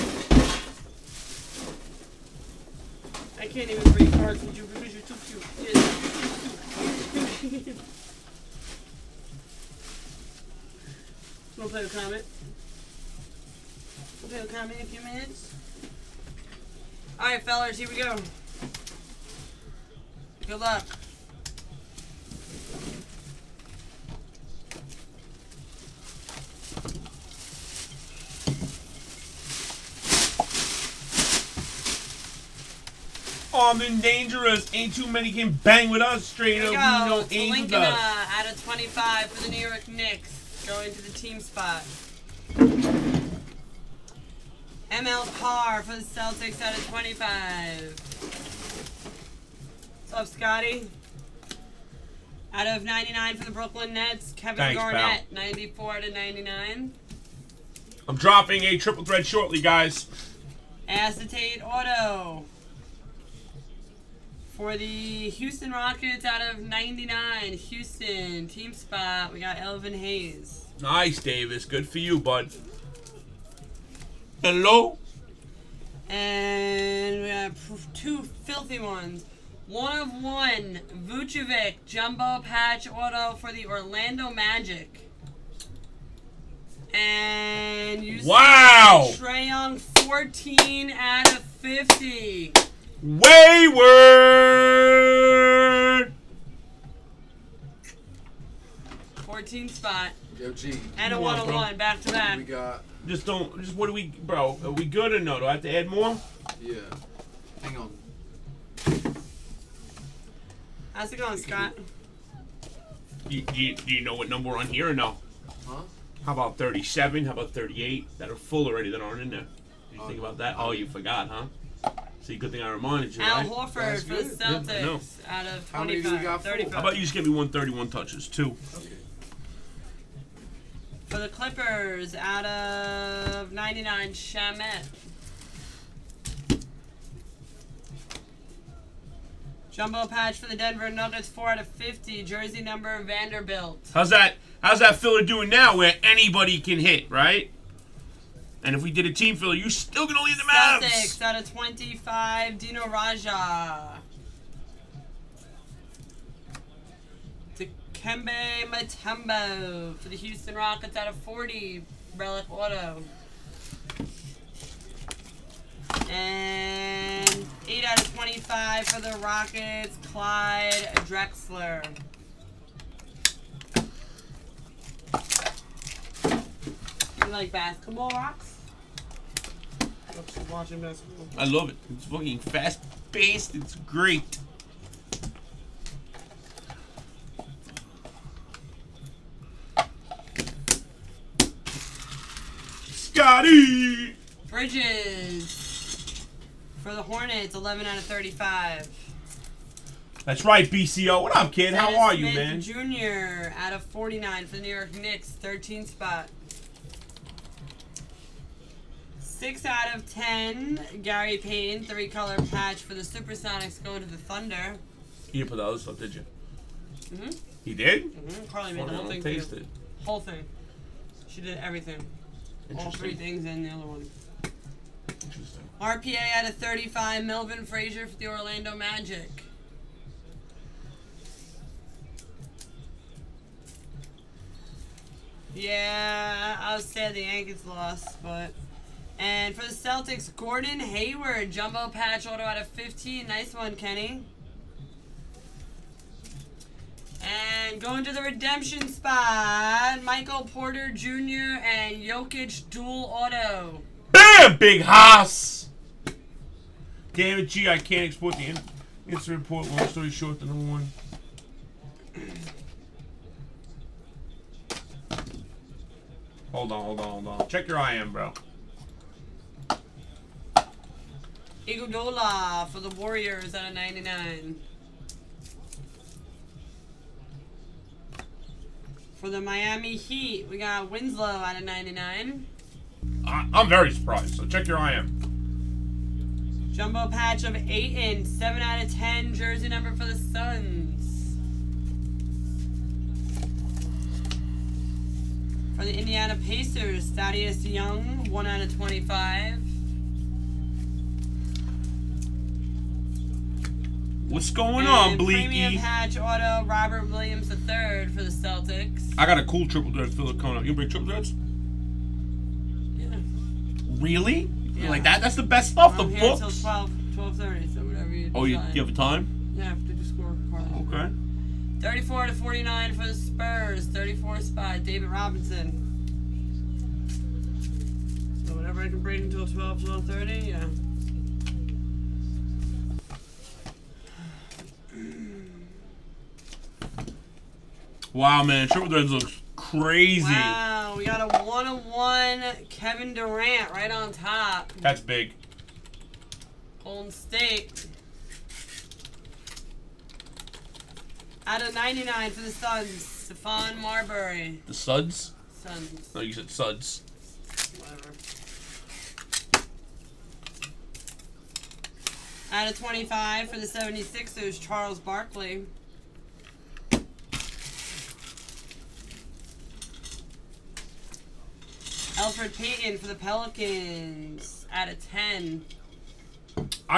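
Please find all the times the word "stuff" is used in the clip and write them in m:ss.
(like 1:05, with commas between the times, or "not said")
3:35, 5:15.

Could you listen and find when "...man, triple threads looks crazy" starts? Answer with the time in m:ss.
5:38.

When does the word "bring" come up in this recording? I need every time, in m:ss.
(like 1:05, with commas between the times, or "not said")
5:10.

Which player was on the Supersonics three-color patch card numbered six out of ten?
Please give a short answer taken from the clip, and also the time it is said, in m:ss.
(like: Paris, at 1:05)
Gary Payton, at 3:31.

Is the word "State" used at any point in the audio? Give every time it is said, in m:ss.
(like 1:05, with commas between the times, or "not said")
5:47.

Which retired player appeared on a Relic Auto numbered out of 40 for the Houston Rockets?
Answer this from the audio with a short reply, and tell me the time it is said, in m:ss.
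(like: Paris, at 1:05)
Mutombo, at 2:38.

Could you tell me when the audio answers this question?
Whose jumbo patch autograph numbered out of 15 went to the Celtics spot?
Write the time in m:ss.
4:00.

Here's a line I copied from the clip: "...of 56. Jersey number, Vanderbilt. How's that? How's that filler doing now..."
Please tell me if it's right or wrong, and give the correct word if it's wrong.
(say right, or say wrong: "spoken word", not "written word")
wrong: "50", not "56".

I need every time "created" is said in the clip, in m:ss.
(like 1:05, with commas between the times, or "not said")
not said.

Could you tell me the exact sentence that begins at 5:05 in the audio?
Premium Patch Auto, Robert Williams the third for the Celtics.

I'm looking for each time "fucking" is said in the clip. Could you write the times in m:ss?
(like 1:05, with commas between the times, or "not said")
3:02.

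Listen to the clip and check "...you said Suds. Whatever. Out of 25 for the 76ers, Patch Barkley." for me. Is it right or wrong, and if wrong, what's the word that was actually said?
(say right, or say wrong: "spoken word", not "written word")
wrong: "Charles", not "Patch".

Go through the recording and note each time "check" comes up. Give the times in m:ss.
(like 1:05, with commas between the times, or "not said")
4:27, 4:44.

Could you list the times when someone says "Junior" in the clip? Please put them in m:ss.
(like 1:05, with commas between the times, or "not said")
3:22.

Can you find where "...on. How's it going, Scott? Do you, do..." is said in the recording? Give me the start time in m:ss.
1:47.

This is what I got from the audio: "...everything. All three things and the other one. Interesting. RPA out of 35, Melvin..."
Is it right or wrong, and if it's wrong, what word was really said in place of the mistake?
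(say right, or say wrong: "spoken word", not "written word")
right.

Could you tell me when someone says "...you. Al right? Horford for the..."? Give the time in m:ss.
2:03.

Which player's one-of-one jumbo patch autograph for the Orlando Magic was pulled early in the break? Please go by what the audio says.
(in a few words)
Vucevic.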